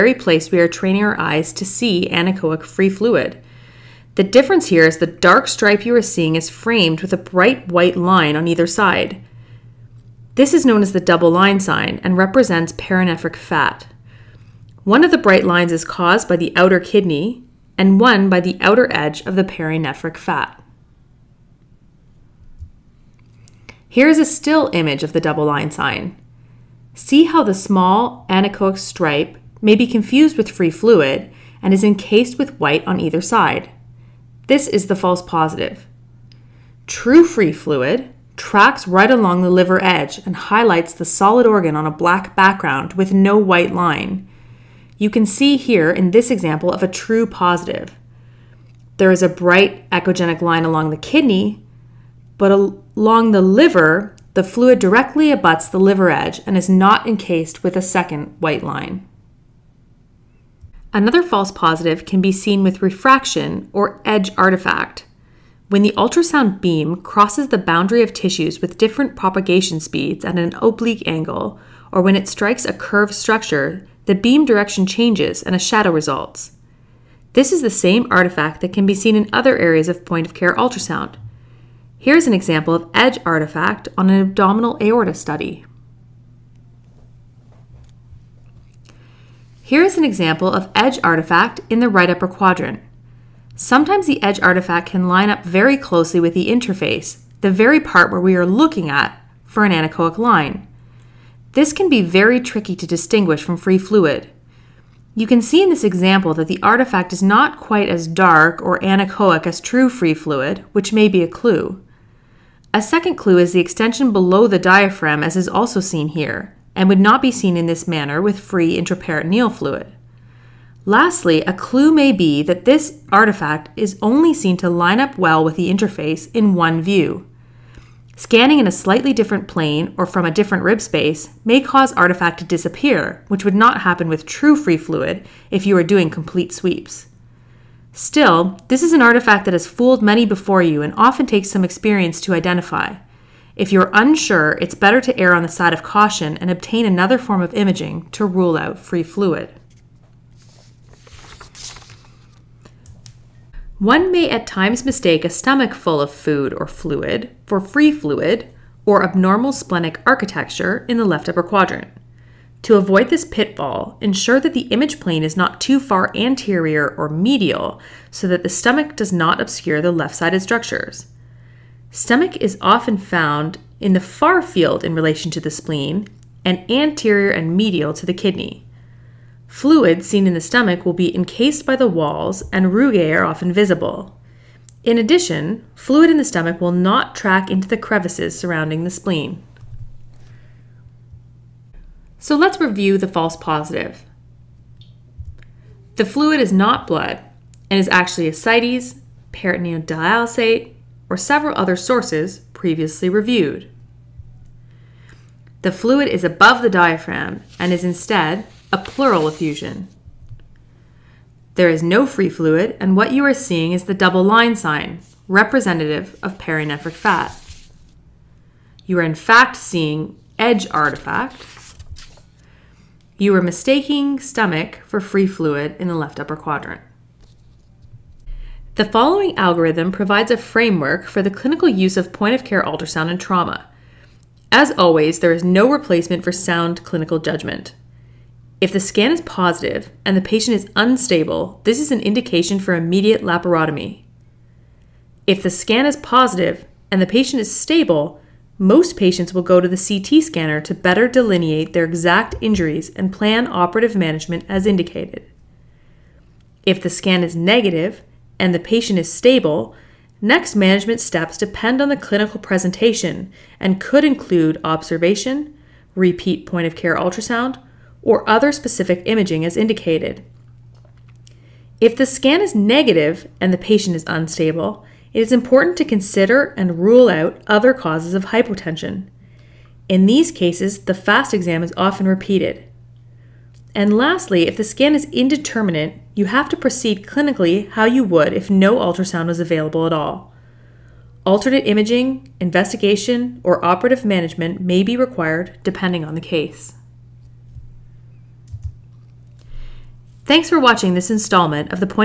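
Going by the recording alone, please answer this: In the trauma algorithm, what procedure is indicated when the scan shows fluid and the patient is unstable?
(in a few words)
immediate laparotomy.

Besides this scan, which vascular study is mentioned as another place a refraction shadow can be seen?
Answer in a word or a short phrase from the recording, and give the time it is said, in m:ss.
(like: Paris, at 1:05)
abdominal aorta study, at 1:24.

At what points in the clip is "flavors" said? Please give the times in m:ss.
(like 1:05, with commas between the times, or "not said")
not said.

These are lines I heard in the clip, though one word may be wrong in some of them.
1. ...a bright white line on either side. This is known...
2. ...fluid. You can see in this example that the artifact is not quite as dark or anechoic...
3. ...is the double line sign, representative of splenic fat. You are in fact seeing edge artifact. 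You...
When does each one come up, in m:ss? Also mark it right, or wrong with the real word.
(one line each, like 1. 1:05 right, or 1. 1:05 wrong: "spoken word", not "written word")
1. 0:07 right
2. 1:43 right
3. 3:33 wrong: "perinephric", not "splenic".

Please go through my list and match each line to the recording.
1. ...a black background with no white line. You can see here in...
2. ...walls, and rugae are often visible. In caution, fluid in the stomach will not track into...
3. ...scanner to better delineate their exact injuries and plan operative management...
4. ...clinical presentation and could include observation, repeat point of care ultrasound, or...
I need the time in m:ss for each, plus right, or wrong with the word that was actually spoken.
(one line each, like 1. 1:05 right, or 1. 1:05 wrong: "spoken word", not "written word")
1. 0:41 right
2. 3:01 wrong: "addition", not "caution"
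3. 4:10 right
4. 4:21 right.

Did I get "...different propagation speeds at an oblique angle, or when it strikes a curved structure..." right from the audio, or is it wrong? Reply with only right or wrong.
right.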